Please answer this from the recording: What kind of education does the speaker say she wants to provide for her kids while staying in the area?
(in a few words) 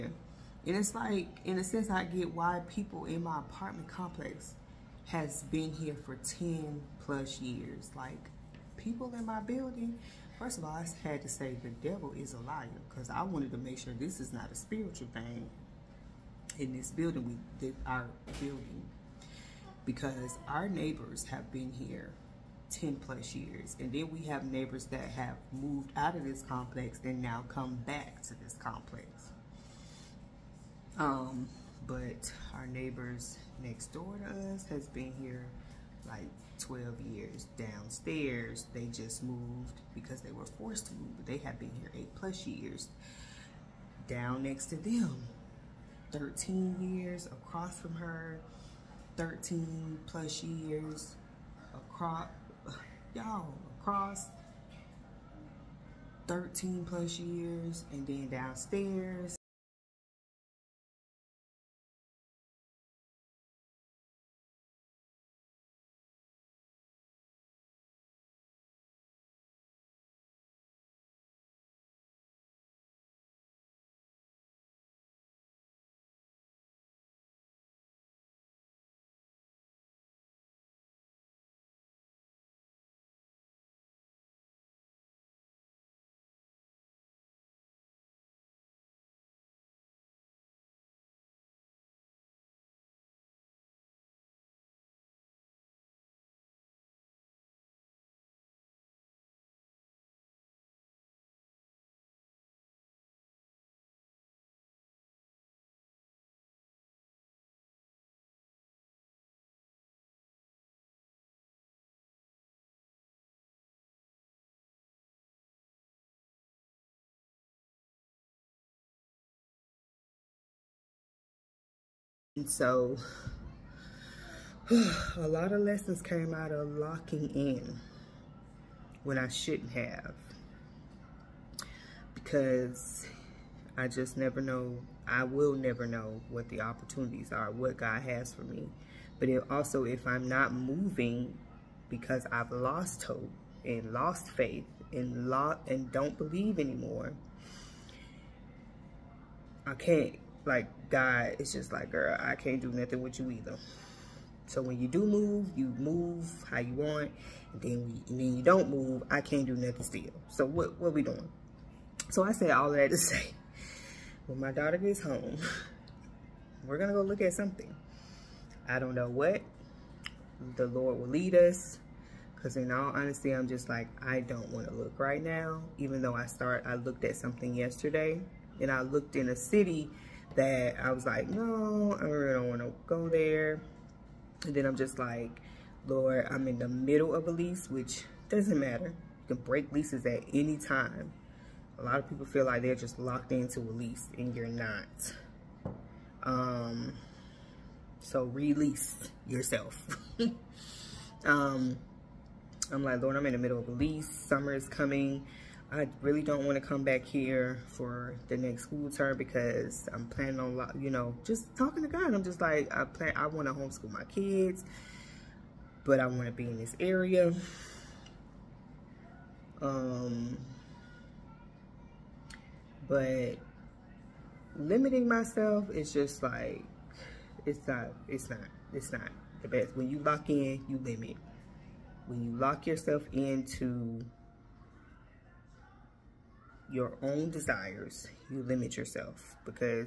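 Homeschool.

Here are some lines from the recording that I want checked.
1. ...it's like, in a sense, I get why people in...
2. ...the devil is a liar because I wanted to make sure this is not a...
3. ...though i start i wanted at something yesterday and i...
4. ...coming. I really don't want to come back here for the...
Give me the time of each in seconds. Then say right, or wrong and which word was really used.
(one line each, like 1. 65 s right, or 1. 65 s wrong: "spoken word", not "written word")
1. 0 s right
2. 11 s right
3. 176 s wrong: "looked", not "wanted"
4. 204 s right.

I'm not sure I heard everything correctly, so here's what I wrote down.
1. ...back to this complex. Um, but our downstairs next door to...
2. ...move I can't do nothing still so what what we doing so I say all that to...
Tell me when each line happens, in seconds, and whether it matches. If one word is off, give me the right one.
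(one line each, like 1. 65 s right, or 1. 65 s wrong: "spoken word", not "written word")
1. 27 s wrong: "neighbors", not "downstairs"
2. 158 s right.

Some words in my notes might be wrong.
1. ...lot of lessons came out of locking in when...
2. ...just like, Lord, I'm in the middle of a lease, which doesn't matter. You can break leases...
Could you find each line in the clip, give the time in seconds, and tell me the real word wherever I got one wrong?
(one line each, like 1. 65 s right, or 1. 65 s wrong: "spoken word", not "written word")
1. 125 s right
2. 184 s right.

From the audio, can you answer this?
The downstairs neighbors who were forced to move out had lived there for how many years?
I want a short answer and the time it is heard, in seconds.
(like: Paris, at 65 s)
8 plus years, at 41 s.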